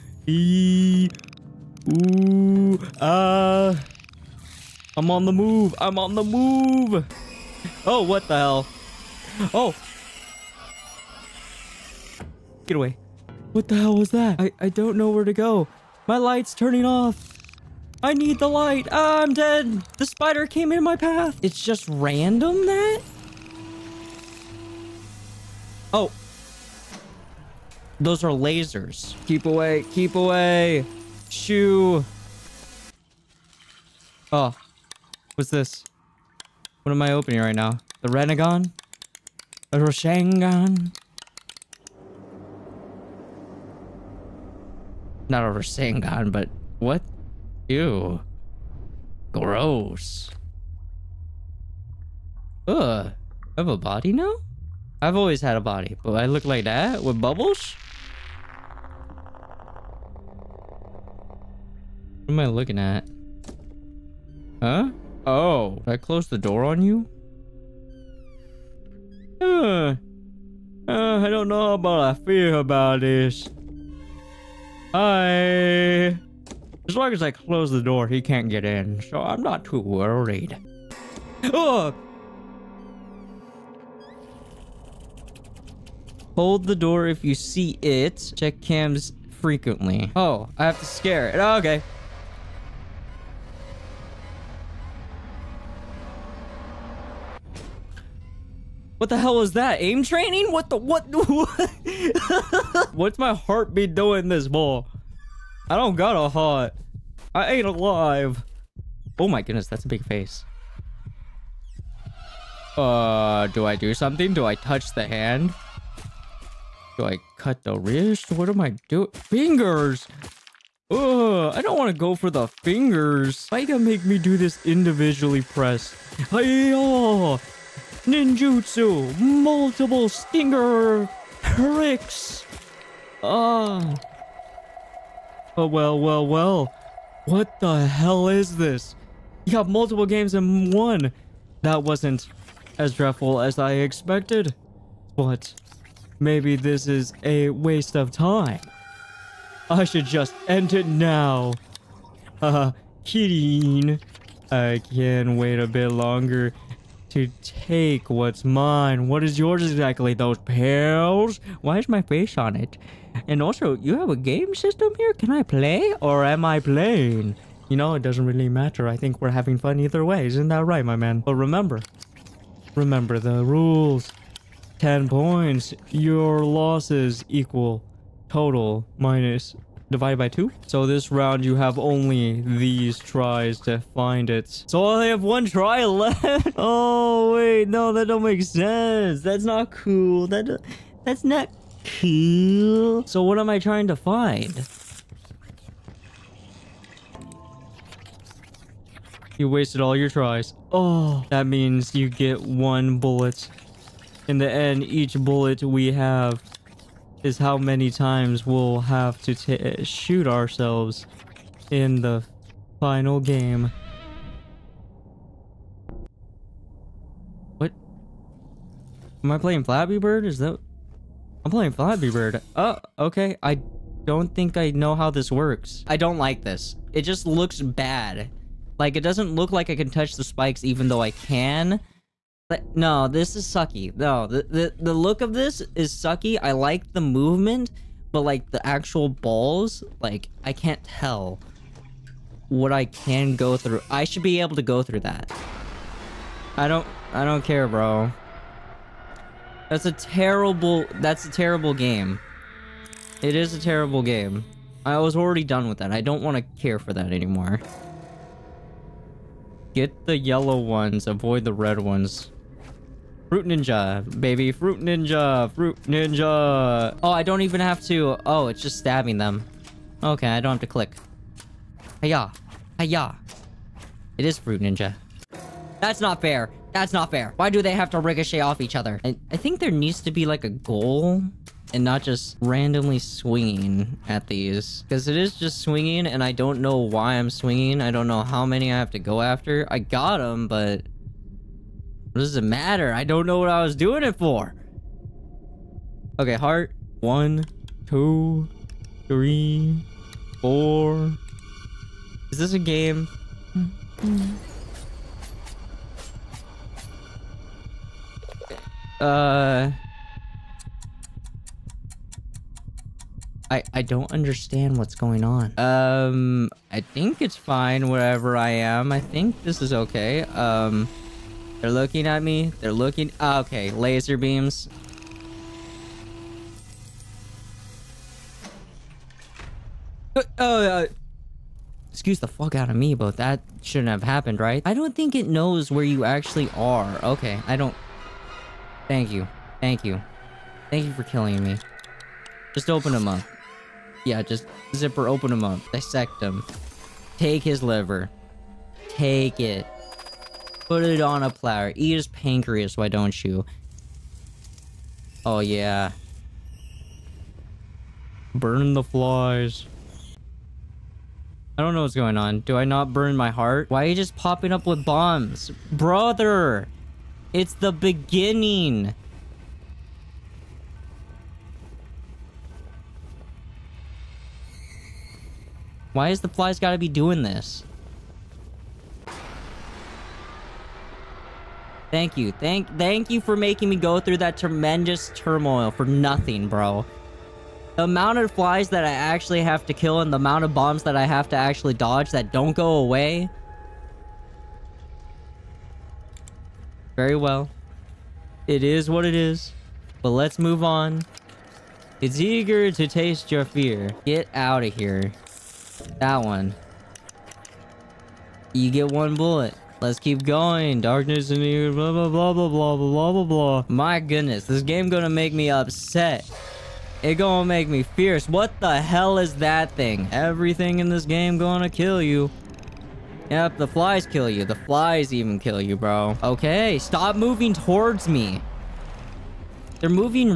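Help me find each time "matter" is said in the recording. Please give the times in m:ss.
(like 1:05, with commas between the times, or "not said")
2:48, 4:52.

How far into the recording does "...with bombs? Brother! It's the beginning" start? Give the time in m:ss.
6:04.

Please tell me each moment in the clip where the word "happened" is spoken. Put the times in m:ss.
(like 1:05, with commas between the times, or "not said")
5:34.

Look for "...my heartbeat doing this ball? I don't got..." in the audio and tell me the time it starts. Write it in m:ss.
1:43.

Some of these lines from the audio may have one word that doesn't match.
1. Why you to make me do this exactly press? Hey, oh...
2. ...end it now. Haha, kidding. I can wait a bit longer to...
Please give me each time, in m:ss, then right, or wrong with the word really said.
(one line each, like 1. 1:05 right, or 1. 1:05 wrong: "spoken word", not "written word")
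1. 2:03 wrong: "individually", not "exactly"
2. 2:30 right.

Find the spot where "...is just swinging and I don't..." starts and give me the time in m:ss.
4:45.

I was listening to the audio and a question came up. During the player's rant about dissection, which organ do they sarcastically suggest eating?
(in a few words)
pancreas.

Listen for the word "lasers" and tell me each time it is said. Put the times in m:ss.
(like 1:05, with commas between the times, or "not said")
0:28, 5:23.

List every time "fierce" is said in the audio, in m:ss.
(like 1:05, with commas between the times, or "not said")
6:57.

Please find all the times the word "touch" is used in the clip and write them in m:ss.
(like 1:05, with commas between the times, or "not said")
1:54, 3:49.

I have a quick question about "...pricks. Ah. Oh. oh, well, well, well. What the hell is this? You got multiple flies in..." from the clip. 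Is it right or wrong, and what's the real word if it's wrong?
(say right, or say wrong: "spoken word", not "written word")
wrong: "games", not "flies".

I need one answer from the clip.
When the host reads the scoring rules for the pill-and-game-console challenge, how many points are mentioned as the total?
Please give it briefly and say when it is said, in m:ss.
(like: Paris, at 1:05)
10 points, at 2:54.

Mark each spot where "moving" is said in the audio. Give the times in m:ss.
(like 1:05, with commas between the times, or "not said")
7:07.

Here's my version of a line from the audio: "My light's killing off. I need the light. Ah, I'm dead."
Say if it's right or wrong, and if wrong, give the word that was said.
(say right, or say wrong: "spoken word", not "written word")
wrong: "turning", not "killing".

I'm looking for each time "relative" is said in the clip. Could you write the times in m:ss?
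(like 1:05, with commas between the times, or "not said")
not said.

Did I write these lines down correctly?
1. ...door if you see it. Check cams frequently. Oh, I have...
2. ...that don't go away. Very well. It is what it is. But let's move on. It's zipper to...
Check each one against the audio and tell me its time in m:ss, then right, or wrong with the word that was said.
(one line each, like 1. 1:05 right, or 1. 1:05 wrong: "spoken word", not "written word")
1. 1:26 right
2. 6:32 wrong: "eager", not "zipper".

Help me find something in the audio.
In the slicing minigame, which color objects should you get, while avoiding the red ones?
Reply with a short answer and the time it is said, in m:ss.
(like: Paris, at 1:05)
yellow, at 4:20.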